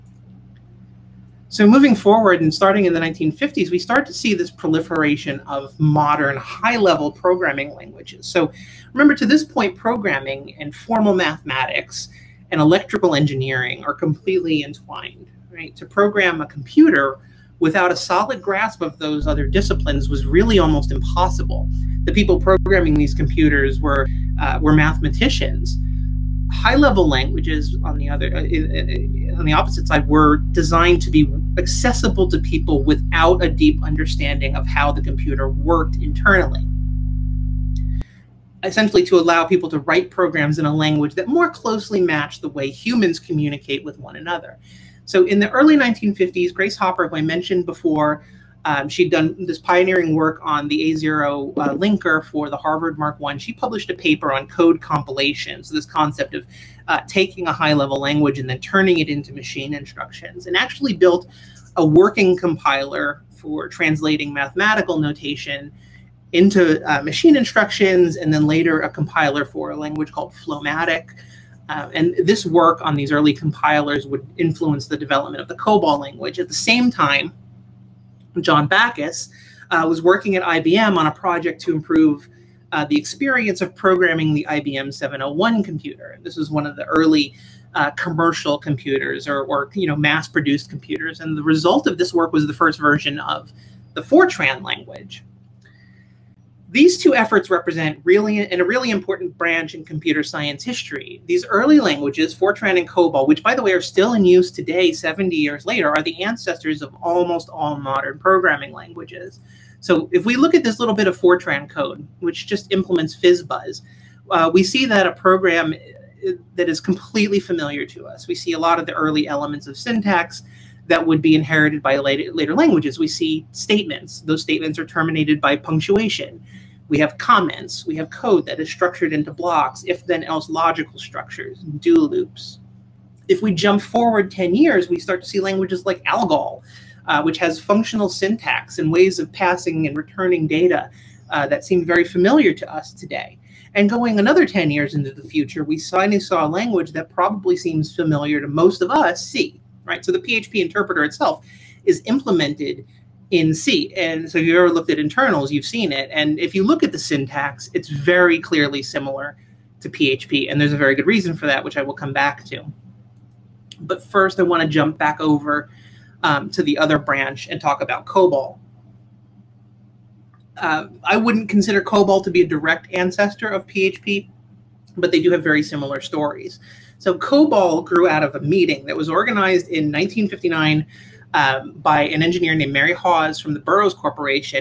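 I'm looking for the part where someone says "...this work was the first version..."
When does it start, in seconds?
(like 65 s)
91 s.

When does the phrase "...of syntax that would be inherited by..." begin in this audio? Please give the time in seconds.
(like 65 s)
119 s.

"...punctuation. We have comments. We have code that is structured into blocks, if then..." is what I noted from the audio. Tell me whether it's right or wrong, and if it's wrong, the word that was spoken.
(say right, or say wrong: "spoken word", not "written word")
right.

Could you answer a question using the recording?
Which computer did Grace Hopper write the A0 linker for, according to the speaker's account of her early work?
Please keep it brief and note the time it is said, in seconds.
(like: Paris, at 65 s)
Harvard Mark I, at 52 s.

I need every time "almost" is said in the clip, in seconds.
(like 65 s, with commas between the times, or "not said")
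20 s, 106 s.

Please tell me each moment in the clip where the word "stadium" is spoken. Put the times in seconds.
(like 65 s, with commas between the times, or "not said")
not said.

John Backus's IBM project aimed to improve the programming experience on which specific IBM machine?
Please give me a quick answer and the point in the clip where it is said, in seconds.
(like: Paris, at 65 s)
IBM 701, at 84 s.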